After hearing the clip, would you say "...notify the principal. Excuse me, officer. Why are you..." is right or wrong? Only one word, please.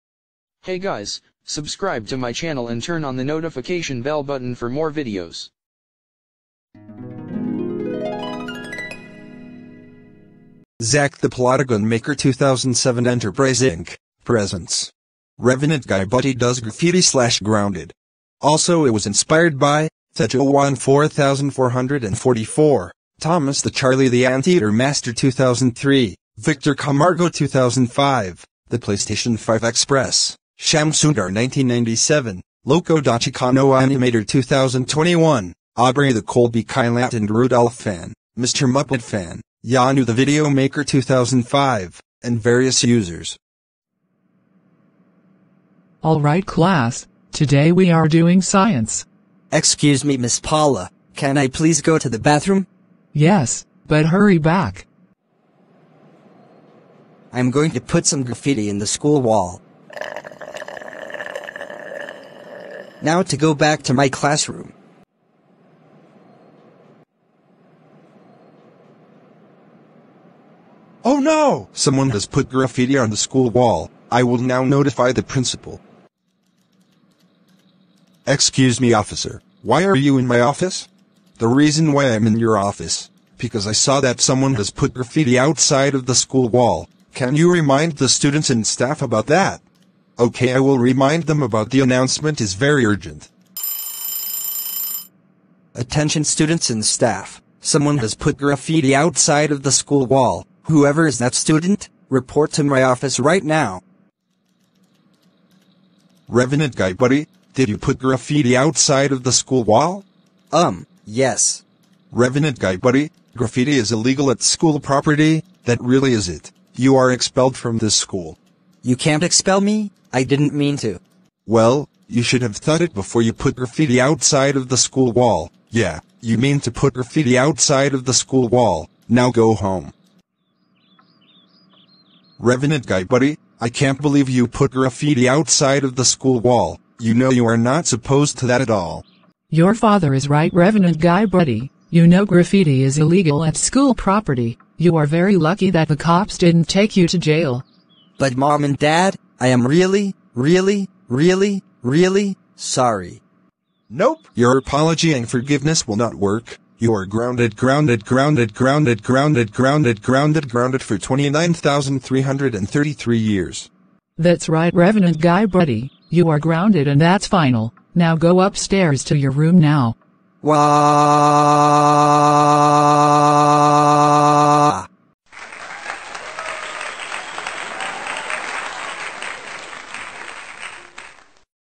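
right.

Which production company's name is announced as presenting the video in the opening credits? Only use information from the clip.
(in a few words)
Zack the Plotagon Maker 2007 Enterprise Inc.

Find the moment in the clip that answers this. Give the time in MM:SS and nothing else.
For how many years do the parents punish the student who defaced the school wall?
02:40.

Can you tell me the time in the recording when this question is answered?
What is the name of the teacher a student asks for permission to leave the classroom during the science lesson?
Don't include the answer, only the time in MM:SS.
00:50.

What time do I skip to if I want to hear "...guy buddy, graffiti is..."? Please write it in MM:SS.
01:52.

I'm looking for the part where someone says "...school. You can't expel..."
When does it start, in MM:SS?
01:57.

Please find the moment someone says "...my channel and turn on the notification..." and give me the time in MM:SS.
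00:02.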